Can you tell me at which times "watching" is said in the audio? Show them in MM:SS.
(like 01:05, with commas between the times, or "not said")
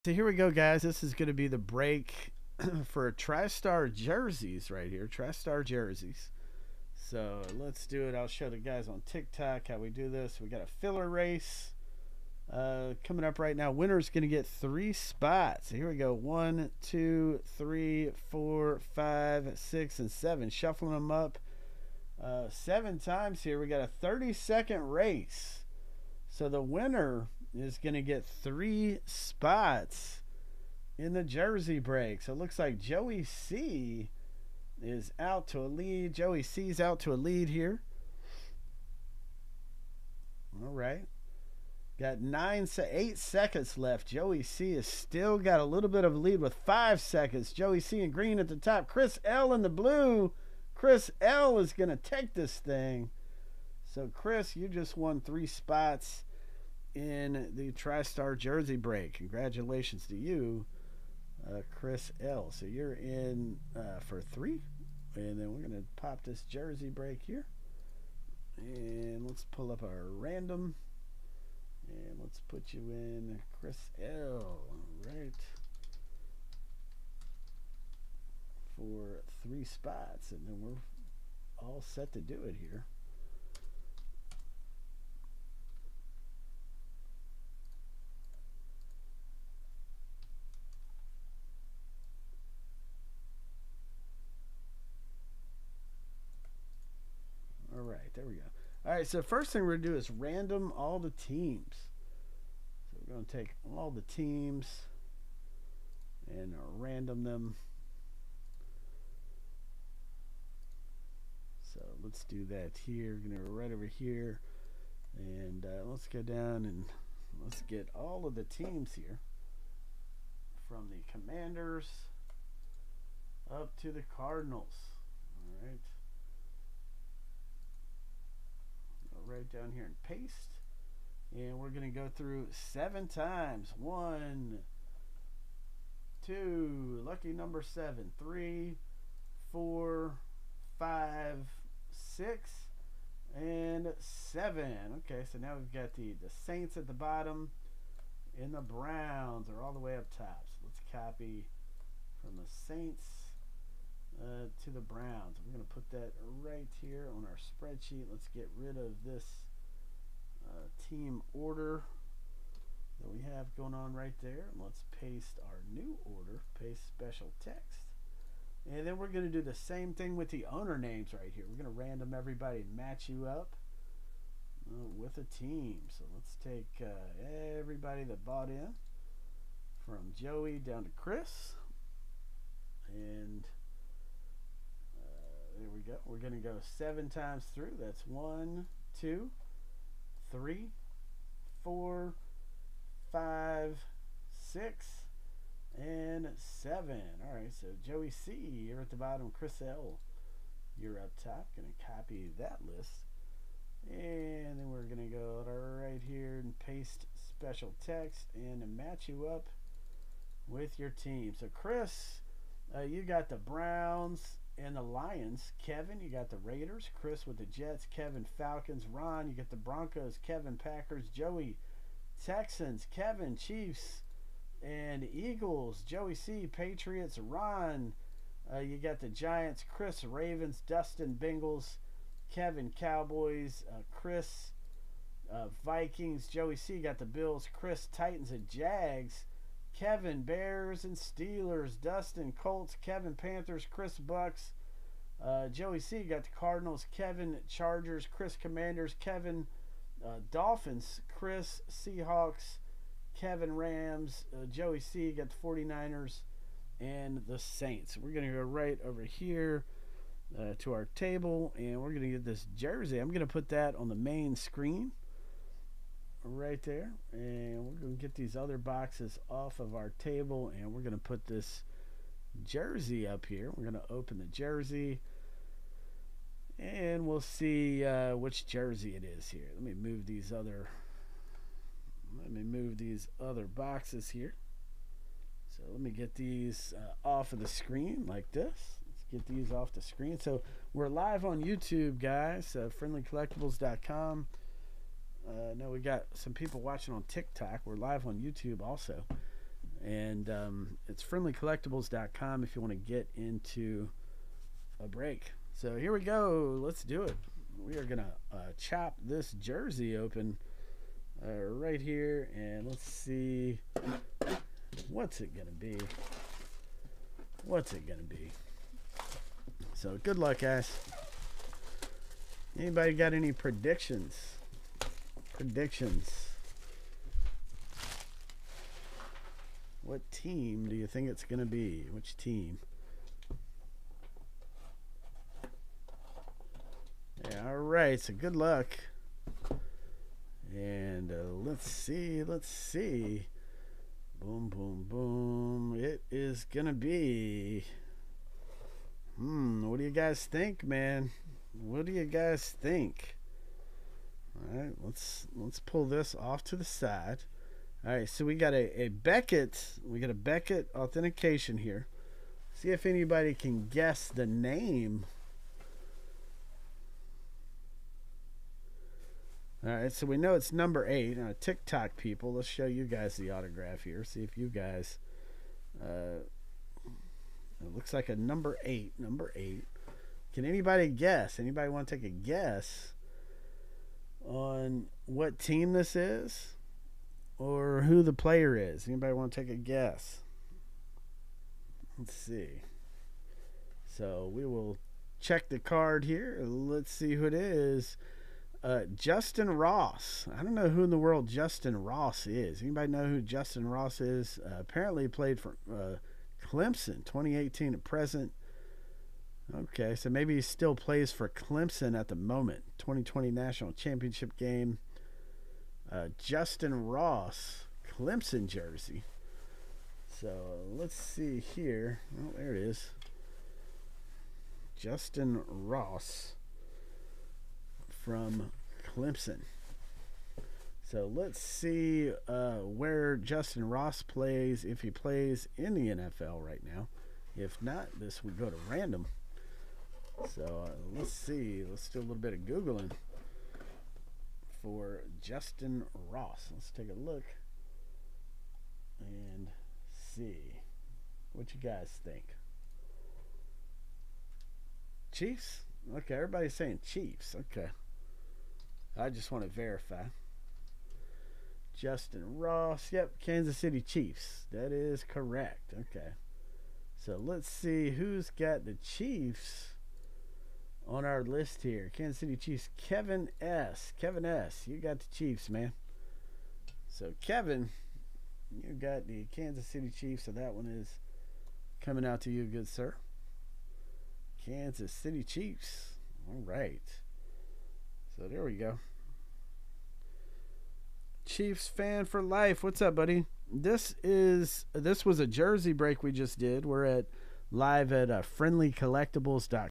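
04:56.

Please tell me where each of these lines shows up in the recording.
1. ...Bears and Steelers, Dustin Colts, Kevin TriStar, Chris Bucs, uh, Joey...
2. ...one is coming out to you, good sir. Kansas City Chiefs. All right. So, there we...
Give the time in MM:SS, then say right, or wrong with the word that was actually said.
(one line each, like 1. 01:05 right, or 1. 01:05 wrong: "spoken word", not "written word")
1. 04:00 wrong: "Panthers", not "TriStar"
2. 08:00 right.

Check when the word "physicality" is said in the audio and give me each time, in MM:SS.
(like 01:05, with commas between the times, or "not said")
not said.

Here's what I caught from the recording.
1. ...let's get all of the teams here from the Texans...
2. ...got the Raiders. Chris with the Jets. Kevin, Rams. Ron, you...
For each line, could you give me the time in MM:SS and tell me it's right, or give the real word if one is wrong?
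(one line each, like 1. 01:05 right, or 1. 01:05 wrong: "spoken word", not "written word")
1. 01:57 wrong: "Commanders", not "Texans"
2. 03:36 wrong: "Falcons", not "Rams".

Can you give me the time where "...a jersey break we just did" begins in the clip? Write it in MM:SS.
08:15.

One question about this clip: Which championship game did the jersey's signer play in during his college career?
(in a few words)
2020 National Championship.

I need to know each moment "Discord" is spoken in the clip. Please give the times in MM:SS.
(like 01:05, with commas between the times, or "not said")
not said.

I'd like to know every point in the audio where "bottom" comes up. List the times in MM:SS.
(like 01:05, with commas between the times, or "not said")
02:26, 03:18.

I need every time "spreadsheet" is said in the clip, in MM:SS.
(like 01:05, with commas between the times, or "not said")
02:37.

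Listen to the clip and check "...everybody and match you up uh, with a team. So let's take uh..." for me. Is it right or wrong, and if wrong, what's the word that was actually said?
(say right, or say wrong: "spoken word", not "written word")
right.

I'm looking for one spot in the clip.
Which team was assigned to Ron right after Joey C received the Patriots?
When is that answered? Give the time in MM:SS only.
03:49.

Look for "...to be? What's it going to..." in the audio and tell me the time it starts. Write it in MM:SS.
05:15.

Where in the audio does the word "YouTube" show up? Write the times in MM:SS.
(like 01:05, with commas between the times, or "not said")
04:51, 04:58.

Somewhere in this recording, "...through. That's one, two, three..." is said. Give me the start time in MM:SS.
03:07.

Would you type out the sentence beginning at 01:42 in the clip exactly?
So we're going to take all the teams and random them.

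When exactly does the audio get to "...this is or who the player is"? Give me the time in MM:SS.
06:25.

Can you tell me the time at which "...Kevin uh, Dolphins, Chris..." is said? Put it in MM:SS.
04:08.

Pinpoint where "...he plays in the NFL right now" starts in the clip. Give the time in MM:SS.
07:14.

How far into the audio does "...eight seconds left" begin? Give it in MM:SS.
00:42.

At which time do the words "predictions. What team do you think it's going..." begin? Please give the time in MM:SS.
05:25.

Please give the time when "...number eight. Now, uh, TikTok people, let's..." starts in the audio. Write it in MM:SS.
06:10.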